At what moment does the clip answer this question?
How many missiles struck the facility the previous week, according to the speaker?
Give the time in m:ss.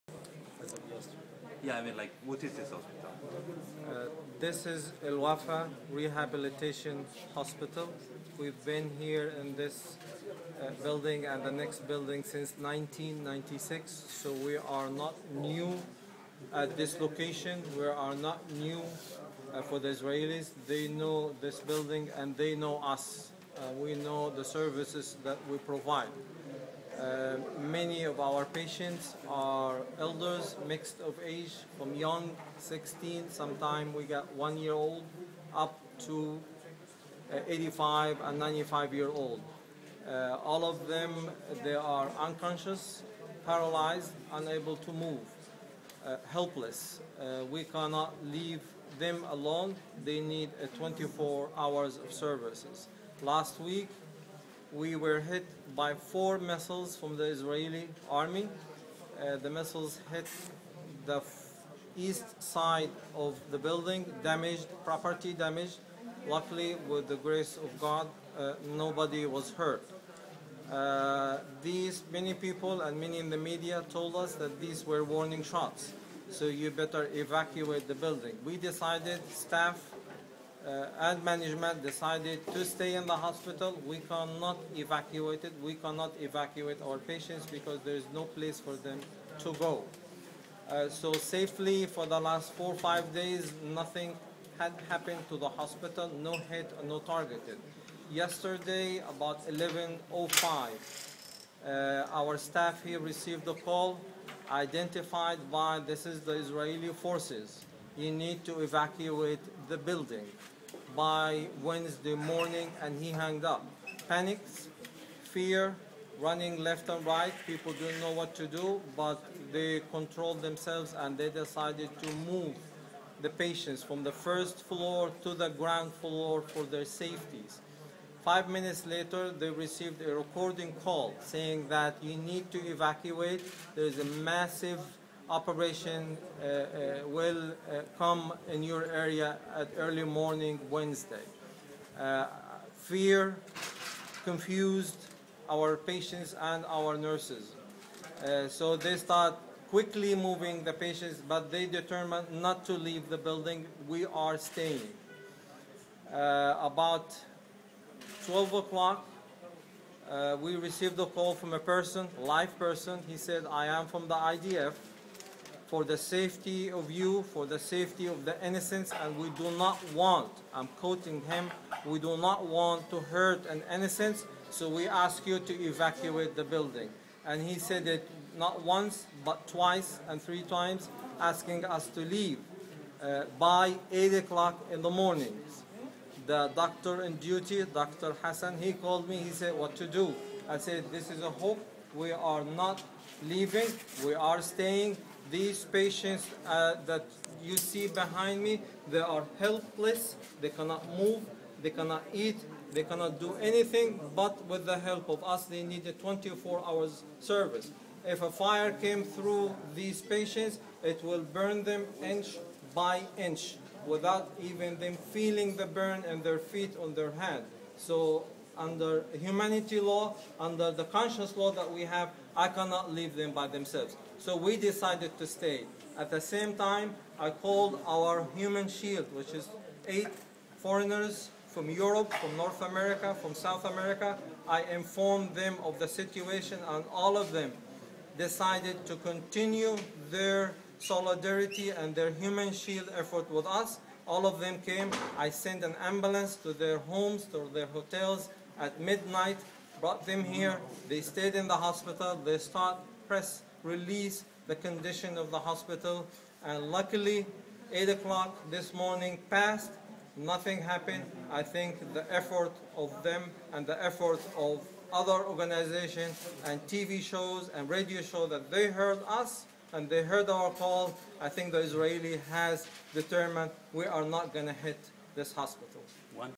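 0:55.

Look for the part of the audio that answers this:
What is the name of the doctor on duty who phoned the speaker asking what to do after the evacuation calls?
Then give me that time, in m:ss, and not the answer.
3:07.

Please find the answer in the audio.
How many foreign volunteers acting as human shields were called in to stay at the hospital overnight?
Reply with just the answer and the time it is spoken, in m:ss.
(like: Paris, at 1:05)
8, at 3:49.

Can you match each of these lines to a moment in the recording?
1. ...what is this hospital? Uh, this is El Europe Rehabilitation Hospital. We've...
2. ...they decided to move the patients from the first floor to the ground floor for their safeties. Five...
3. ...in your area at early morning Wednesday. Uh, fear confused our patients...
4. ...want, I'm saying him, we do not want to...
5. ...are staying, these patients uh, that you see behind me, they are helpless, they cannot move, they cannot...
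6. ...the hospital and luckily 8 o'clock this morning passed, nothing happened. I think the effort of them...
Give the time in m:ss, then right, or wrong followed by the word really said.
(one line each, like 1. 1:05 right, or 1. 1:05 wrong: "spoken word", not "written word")
1. 0:02 wrong: "Wafa", not "Europe"
2. 2:01 right
3. 2:18 right
4. 2:49 wrong: "quoting", not "saying"
5. 3:14 right
6. 4:15 right.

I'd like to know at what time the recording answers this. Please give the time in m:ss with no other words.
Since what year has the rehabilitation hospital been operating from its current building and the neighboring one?
0:12.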